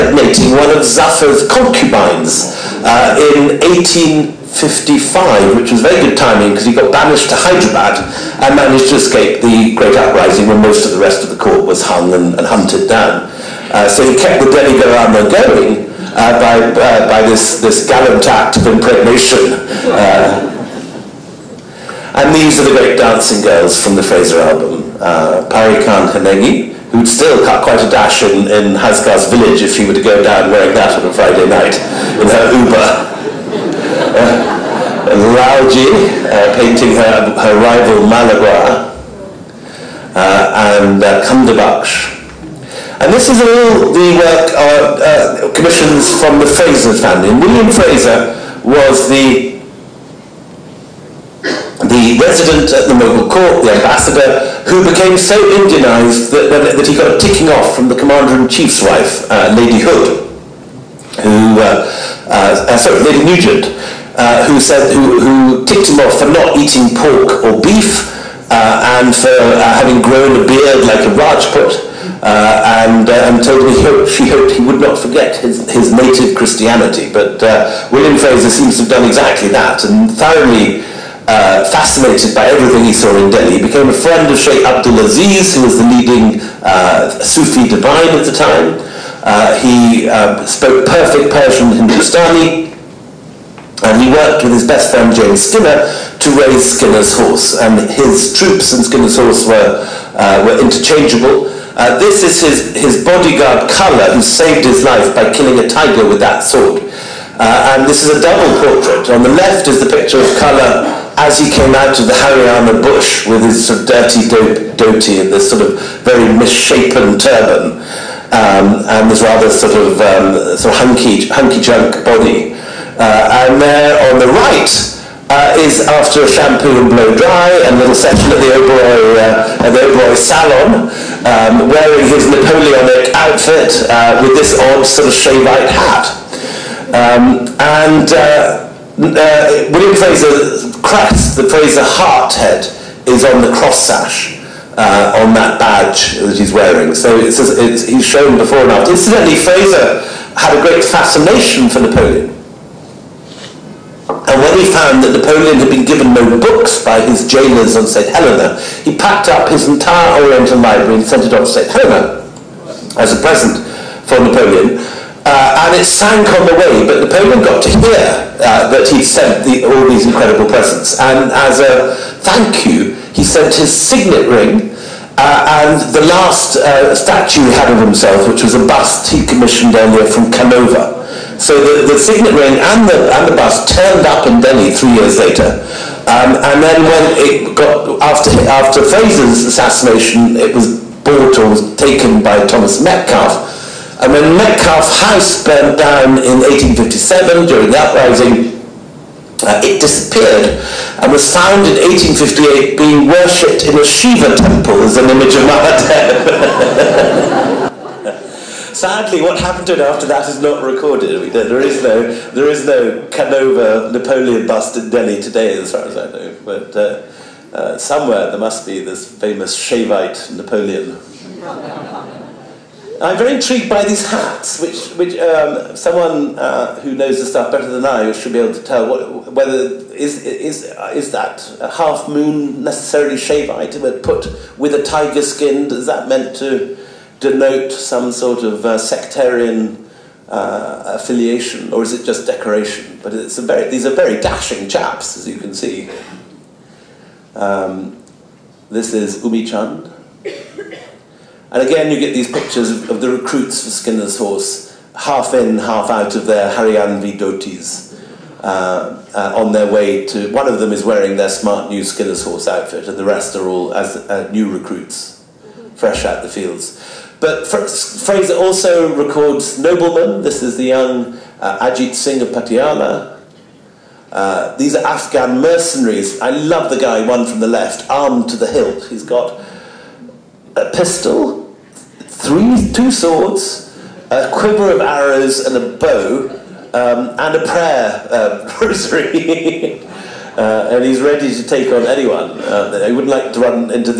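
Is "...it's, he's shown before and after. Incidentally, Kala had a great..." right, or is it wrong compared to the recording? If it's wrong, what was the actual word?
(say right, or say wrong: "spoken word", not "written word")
wrong: "Fraser", not "Kala".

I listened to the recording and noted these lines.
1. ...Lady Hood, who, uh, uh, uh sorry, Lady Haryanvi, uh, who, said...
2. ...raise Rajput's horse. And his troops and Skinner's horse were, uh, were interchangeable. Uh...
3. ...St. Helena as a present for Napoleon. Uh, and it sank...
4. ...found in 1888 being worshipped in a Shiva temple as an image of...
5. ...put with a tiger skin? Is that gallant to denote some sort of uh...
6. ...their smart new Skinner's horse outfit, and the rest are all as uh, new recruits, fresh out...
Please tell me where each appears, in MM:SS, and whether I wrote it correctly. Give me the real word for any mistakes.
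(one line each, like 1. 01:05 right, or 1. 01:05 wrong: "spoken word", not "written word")
1. 00:59 wrong: "Nugent", not "Haryanvi"
2. 01:36 wrong: "Skinner", not "Rajput"
3. 02:41 right
4. 03:21 wrong: "1858", not "1888"
5. 03:54 wrong: "meant", not "gallant"
6. 04:21 right.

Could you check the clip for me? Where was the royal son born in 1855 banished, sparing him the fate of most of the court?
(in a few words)
Hyderabad.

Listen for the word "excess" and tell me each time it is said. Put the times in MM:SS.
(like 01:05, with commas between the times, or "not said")
not said.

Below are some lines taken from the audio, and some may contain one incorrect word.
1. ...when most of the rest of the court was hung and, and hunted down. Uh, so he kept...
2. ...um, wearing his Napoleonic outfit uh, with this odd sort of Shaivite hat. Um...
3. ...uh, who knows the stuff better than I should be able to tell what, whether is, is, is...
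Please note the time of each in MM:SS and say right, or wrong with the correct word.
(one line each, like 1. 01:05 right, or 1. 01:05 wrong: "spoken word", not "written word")
1. 00:10 right
2. 02:11 right
3. 03:46 right.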